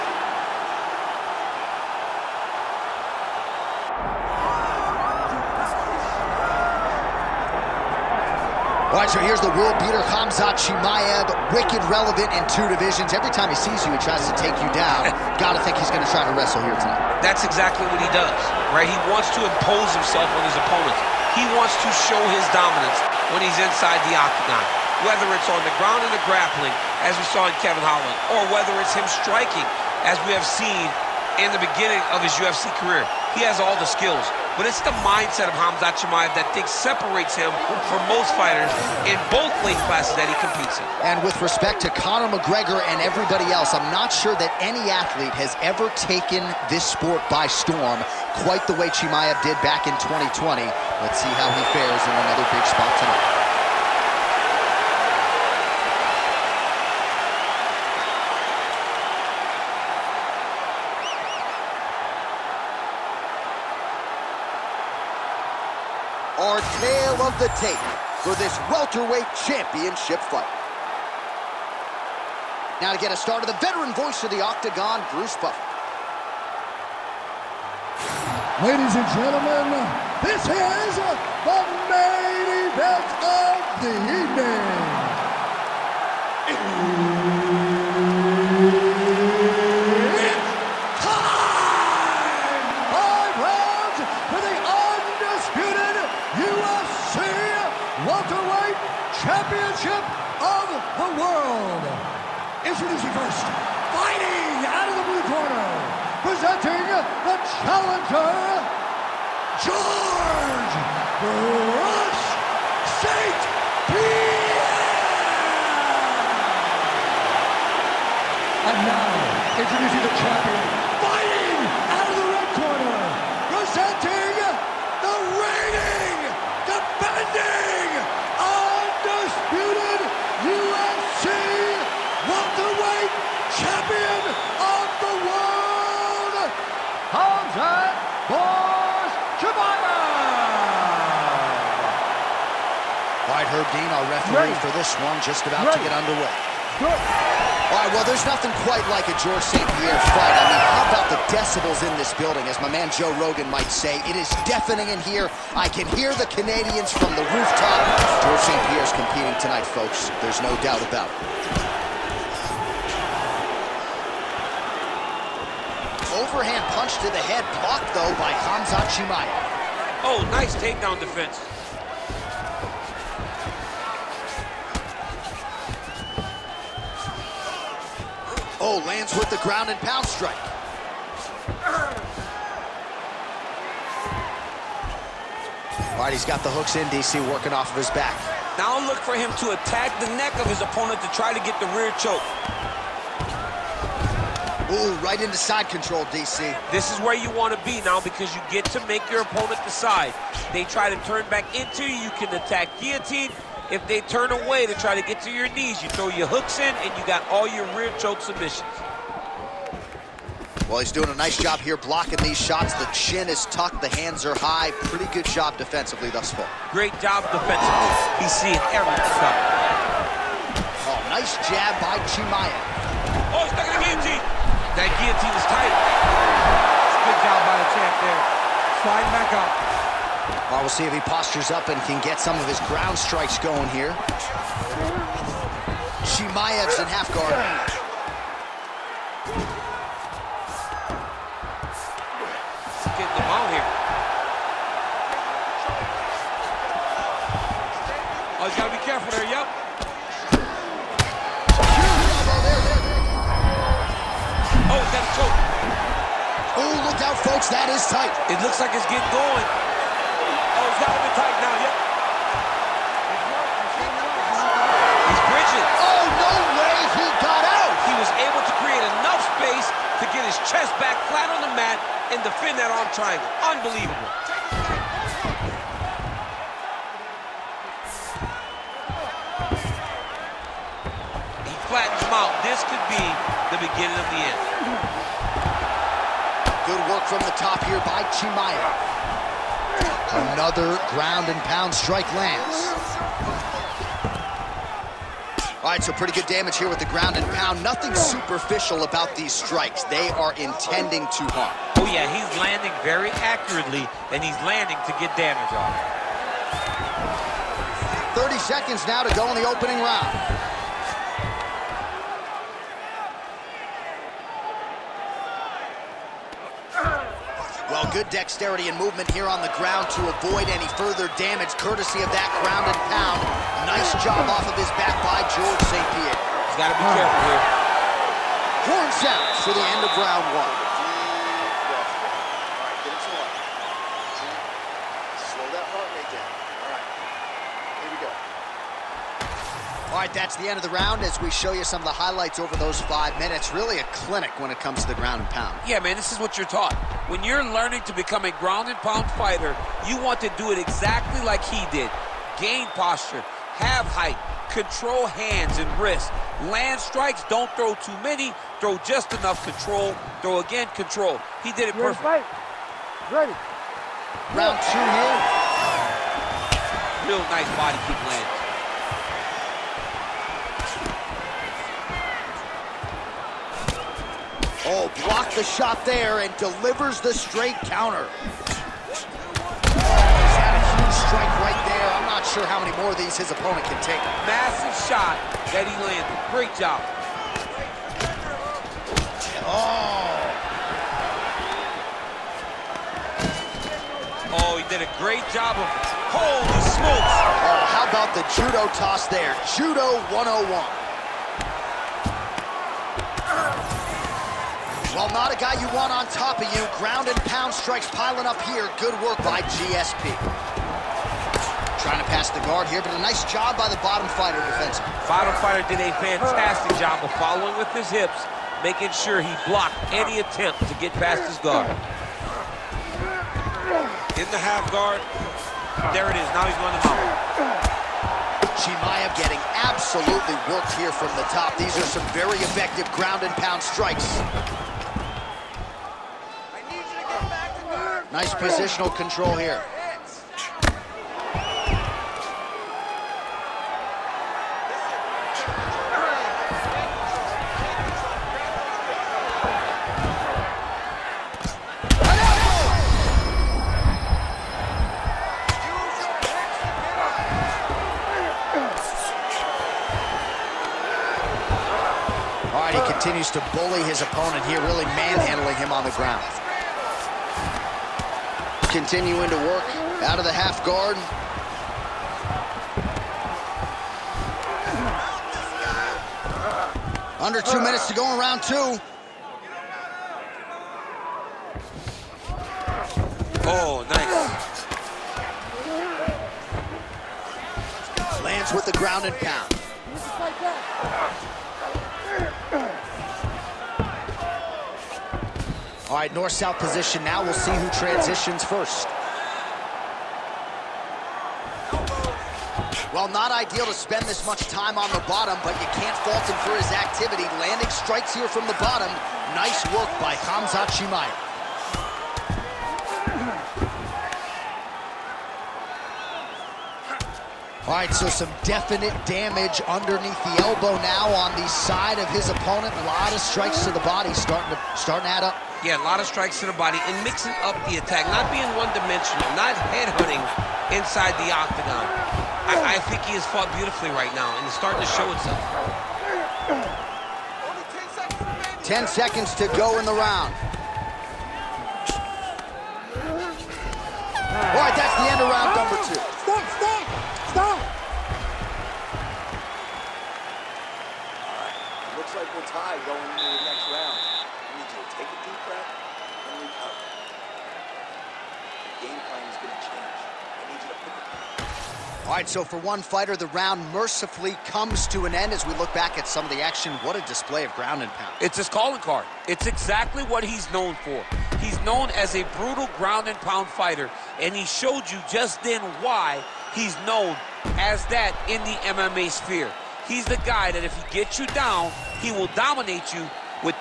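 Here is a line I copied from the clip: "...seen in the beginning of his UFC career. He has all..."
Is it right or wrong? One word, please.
right.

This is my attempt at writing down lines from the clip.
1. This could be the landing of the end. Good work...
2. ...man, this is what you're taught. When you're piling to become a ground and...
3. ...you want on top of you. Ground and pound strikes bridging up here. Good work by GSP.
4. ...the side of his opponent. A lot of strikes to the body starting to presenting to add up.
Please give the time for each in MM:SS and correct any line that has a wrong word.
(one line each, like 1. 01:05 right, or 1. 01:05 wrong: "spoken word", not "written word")
1. 04:42 wrong: "beginning", not "landing"
2. 05:45 wrong: "learning", not "piling"
3. 06:45 wrong: "piling", not "bridging"
4. 08:41 wrong: "starting", not "presenting".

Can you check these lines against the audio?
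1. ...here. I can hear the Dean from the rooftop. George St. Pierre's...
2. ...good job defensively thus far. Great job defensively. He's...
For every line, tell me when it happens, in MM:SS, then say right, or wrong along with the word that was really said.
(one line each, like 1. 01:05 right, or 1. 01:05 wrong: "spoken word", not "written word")
1. 02:35 wrong: "Canadians", not "Dean"
2. 03:35 right.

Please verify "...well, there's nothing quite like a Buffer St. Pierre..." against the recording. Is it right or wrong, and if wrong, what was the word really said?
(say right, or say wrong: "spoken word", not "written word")
wrong: "George", not "Buffer".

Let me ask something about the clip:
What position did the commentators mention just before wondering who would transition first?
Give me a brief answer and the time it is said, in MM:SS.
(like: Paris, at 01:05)
North-south, at 08:16.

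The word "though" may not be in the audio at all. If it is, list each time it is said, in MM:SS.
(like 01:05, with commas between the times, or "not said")
02:47.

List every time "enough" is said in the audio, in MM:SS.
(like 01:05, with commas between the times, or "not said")
04:29, 05:59.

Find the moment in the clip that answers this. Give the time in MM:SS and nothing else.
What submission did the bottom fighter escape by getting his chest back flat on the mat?
04:32.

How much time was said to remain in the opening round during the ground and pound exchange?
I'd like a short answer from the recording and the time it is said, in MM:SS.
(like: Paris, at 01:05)
30 seconds, at 05:08.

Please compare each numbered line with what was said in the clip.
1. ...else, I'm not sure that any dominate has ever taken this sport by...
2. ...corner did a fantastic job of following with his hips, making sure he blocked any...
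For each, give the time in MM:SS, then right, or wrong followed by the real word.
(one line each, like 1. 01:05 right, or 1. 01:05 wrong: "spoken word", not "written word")
1. 00:43 wrong: "athlete", not "dominate"
2. 06:55 wrong: "fighter", not "corner".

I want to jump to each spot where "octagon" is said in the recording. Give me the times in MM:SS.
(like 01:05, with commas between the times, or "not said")
00:24, 01:14, 08:51.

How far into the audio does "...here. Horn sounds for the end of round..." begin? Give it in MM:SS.
05:27.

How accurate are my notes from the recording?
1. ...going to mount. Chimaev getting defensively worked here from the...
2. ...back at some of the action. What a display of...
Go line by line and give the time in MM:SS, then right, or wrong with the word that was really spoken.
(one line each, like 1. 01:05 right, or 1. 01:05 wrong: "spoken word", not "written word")
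1. 07:06 wrong: "absolutely", not "defensively"
2. 09:25 right.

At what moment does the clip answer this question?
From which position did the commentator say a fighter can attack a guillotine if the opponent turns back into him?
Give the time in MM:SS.
03:15.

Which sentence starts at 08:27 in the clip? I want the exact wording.
Landing strikes here from the bottom.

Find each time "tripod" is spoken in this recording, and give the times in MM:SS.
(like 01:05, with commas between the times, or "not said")
not said.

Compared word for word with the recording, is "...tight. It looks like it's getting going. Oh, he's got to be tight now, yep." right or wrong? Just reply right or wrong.
right.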